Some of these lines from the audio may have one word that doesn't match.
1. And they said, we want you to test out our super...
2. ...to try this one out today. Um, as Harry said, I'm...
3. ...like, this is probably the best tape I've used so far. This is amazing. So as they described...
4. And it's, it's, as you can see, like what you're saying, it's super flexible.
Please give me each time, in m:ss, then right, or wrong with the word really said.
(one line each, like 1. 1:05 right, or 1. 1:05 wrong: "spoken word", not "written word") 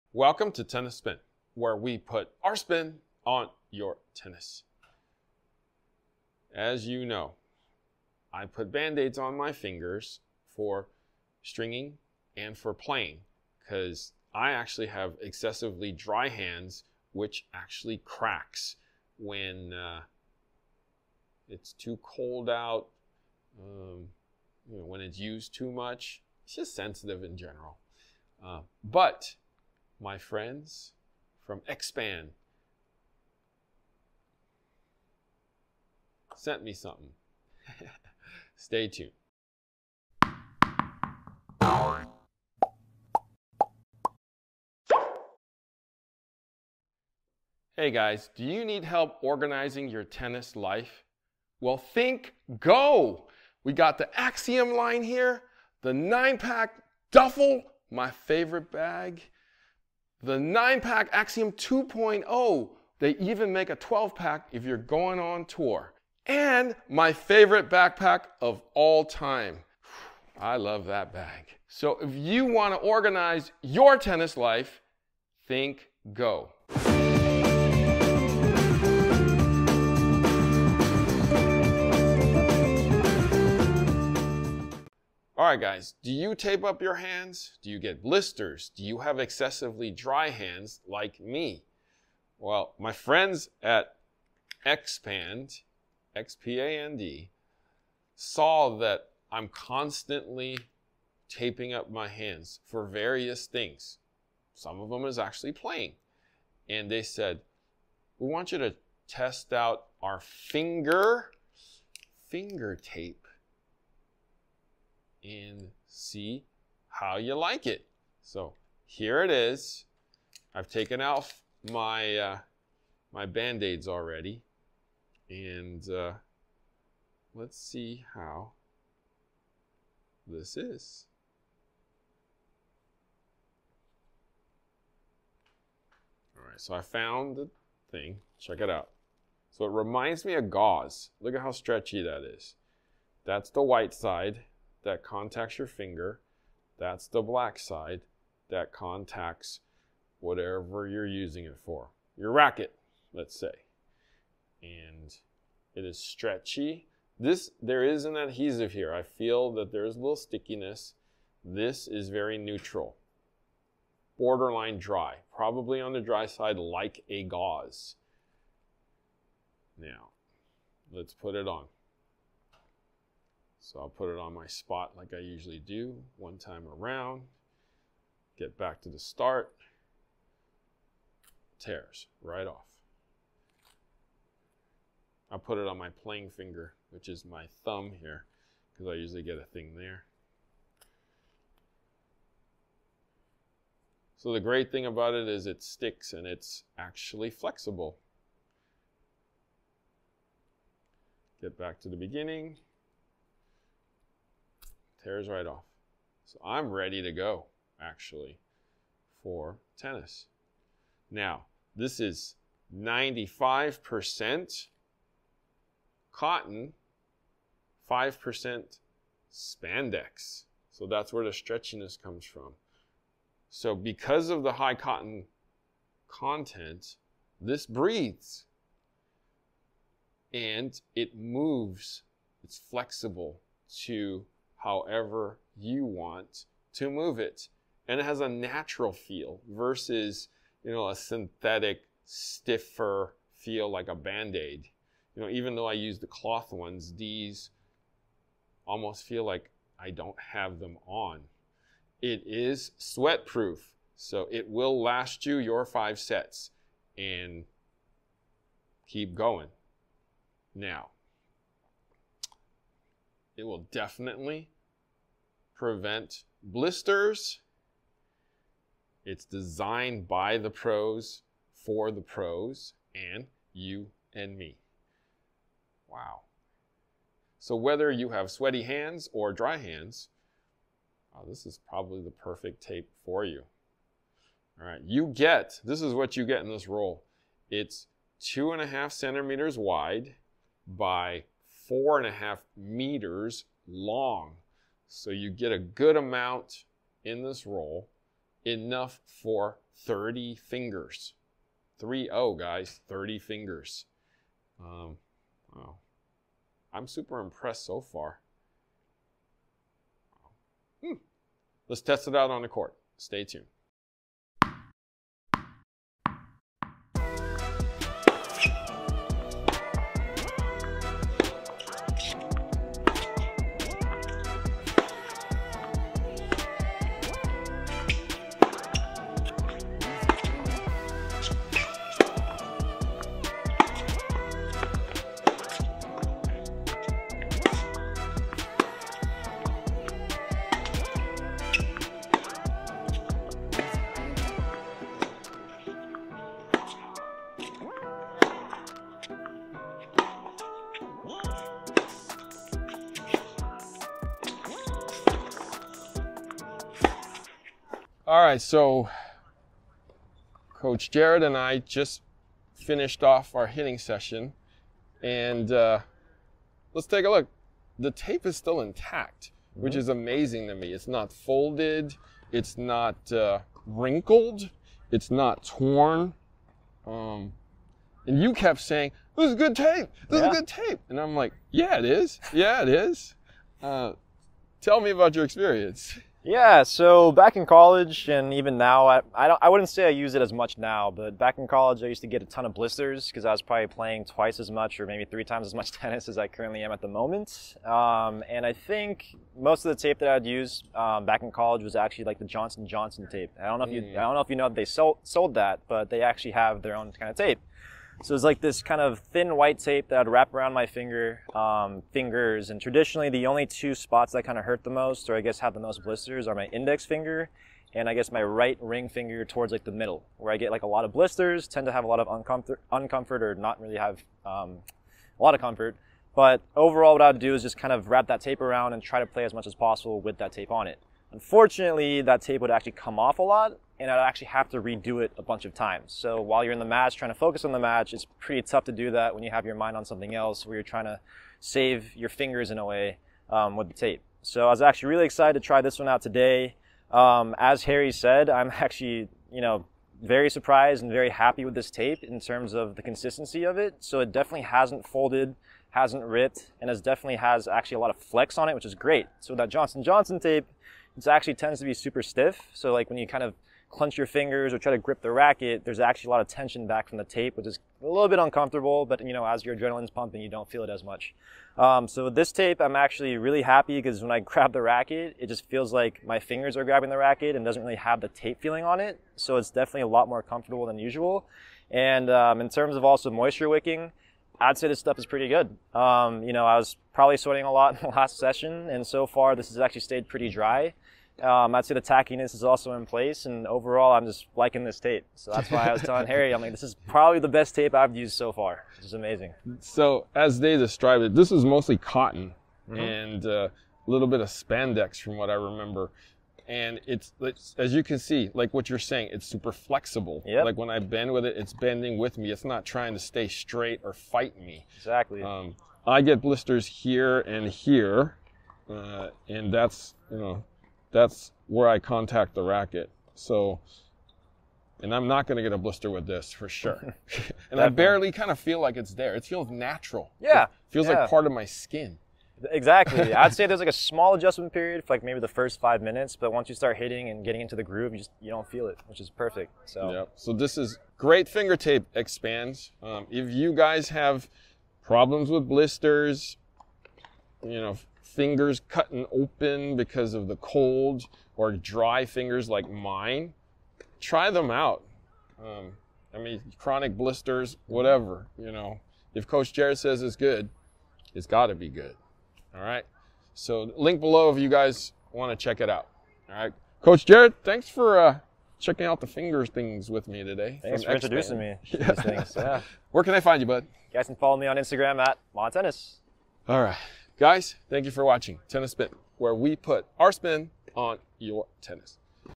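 1. 1:46 wrong: "finger", not "super"
2. 7:25 right
3. 8:16 right
4. 8:26 right.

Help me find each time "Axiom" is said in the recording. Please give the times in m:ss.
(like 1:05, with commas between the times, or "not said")
0:54, 1:01.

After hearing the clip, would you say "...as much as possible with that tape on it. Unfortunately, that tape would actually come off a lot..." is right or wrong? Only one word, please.
right.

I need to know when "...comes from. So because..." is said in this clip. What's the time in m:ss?
3:42.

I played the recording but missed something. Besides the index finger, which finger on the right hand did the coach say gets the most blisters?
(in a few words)
Ring finger.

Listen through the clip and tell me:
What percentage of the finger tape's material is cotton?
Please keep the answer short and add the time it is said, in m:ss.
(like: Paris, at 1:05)
95%, at 3:32.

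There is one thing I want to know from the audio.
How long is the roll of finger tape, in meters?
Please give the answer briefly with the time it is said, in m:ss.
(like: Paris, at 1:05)
4.5 meters, at 4:51.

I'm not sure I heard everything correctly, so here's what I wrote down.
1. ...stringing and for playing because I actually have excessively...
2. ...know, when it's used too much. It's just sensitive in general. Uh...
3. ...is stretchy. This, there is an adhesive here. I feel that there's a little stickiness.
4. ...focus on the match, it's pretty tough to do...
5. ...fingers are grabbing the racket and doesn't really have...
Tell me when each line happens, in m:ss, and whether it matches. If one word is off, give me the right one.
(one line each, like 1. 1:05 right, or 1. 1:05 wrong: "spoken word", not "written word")
1. 0:11 right
2. 0:24 right
3. 2:35 right
4. 7:17 right
5. 7:56 right.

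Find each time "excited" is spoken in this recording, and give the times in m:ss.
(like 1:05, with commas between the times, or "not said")
7:25.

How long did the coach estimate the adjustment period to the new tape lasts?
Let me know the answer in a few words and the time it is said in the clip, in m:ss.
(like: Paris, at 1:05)
5 minutes, at 8:55.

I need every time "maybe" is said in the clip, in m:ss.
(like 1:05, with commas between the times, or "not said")
6:34, 8:55.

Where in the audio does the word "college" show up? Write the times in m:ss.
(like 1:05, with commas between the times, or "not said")
6:27, 6:31, 6:41.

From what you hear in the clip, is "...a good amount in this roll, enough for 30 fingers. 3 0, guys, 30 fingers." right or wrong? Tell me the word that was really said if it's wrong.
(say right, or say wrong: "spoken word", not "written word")
right.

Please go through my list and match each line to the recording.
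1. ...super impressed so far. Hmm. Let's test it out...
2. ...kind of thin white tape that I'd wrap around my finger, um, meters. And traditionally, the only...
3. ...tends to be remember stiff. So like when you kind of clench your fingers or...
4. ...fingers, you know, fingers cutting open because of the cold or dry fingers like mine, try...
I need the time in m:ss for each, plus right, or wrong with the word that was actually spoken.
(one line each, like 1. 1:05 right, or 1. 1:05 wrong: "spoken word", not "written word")
1. 5:06 right
2. 6:48 wrong: "fingers", not "meters"
3. 7:41 wrong: "super", not "remember"
4. 9:05 wrong: "blisters", not "fingers".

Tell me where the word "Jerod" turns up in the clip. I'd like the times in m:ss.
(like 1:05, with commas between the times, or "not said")
6:00, 9:19, 9:27.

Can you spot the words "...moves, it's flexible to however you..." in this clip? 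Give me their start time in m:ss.
3:51.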